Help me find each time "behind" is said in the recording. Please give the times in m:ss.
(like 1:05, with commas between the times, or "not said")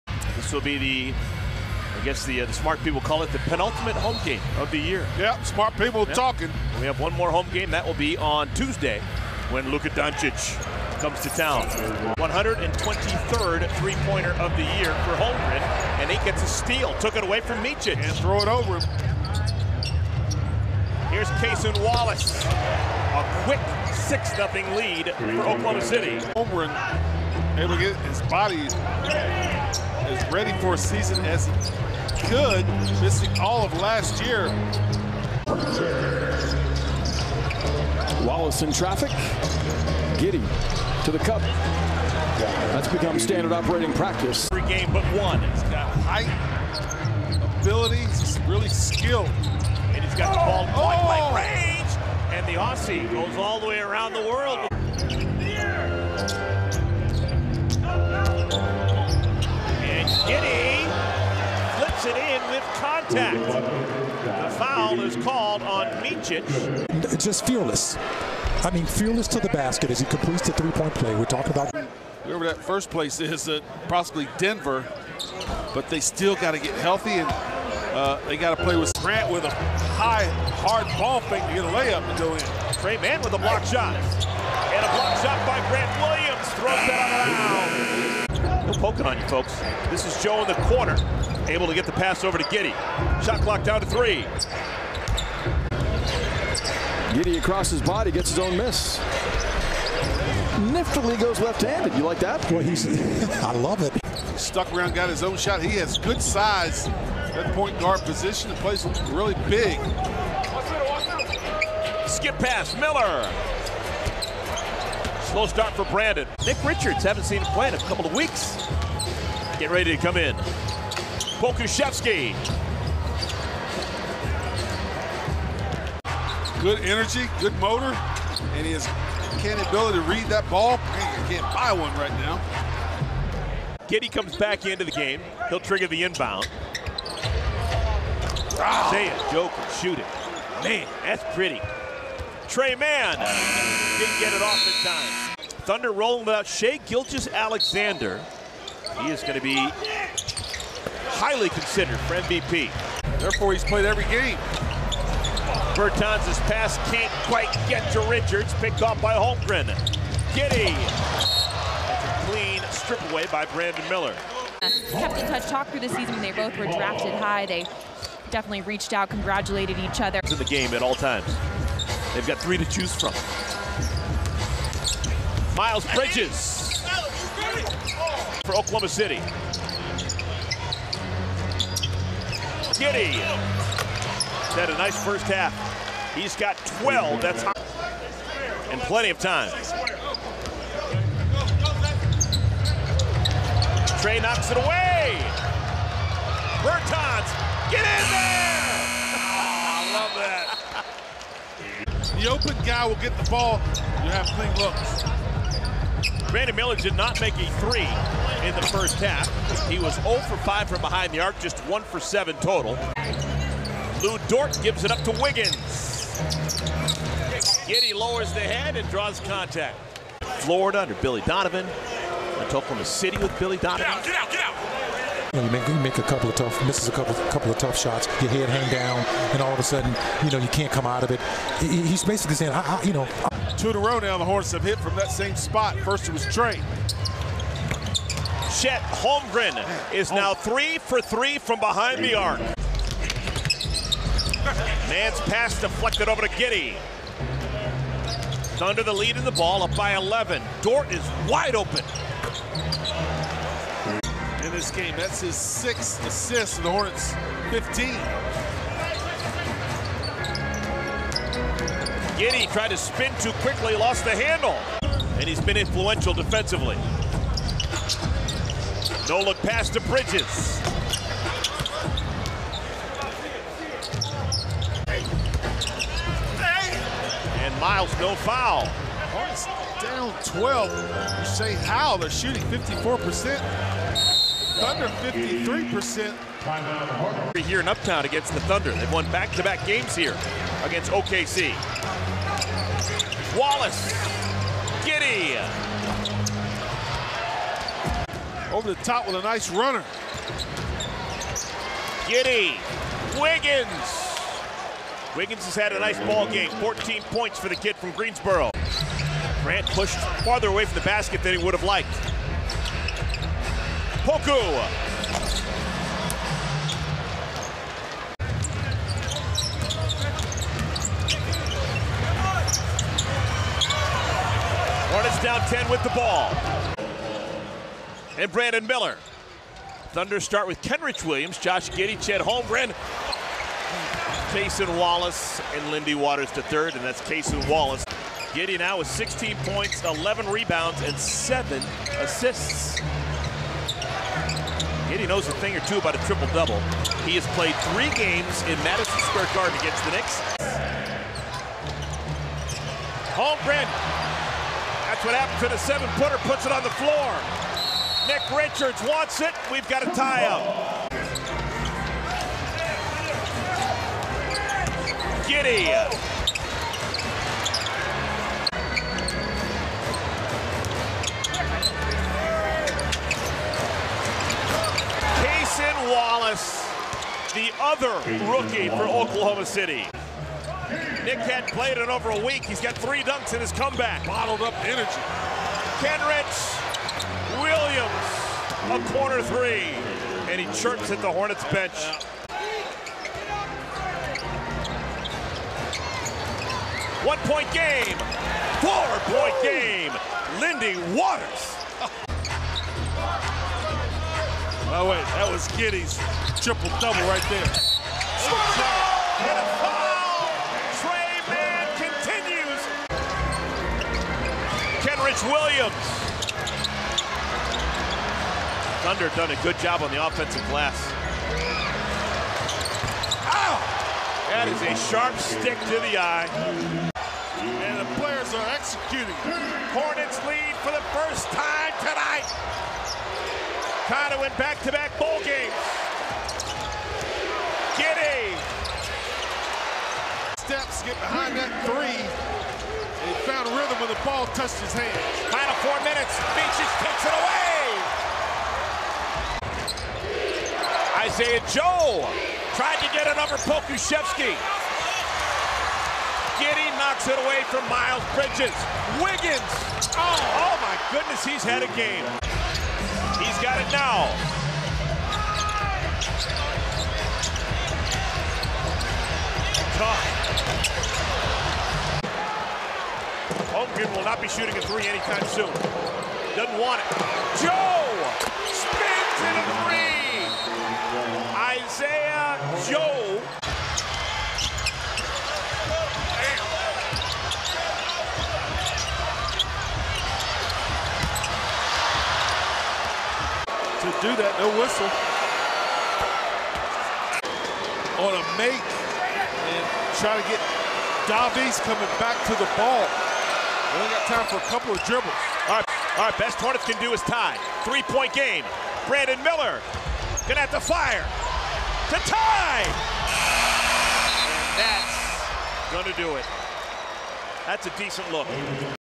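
3:30, 4:01, 7:20.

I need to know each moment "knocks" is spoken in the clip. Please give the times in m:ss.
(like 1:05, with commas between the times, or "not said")
3:14, 7:36.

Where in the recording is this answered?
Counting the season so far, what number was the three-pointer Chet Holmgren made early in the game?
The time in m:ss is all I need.
0:12.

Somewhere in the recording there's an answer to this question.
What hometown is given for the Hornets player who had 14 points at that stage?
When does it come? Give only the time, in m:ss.
5:07.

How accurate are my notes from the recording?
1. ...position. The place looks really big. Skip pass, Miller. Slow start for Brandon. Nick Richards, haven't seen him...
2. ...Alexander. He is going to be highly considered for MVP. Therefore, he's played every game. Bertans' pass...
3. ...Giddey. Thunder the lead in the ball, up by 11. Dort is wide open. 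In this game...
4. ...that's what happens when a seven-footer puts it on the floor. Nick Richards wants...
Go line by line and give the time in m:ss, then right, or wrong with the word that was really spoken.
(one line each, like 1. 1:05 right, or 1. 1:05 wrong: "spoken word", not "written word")
1. 1:48 right
2. 2:27 right
3. 4:06 right
4. 5:54 right.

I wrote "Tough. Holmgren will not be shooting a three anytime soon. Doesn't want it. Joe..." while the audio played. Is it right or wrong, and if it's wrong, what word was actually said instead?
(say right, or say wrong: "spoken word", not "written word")
right.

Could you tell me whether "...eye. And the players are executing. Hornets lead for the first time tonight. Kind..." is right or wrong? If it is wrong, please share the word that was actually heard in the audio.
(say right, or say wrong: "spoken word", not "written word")
right.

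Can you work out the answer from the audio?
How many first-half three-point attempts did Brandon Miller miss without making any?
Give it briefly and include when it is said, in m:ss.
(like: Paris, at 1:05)
5, at 3:29.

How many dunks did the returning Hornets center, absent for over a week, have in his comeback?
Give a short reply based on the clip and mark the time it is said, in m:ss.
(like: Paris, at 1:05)
3, at 6:22.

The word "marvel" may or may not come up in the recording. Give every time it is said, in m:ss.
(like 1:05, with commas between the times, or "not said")
not said.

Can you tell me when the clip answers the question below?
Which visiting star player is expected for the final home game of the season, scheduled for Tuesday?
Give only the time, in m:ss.
0:09.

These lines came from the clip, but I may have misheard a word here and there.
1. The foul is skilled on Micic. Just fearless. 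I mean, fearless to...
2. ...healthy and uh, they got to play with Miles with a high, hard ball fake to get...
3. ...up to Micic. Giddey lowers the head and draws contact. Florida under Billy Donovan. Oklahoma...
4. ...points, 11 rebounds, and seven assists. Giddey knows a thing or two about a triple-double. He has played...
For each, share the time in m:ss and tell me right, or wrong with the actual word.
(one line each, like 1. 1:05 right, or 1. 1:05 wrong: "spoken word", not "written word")
1. 1:03 wrong: "called", not "skilled"
2. 1:16 wrong: "Grant", not "Miles"
3. 3:34 wrong: "Wiggins", not "Micic"
4. 5:39 right.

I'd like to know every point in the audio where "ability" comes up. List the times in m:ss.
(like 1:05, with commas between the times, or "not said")
0:47, 2:09.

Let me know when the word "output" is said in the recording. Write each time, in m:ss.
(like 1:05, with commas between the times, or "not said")
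not said.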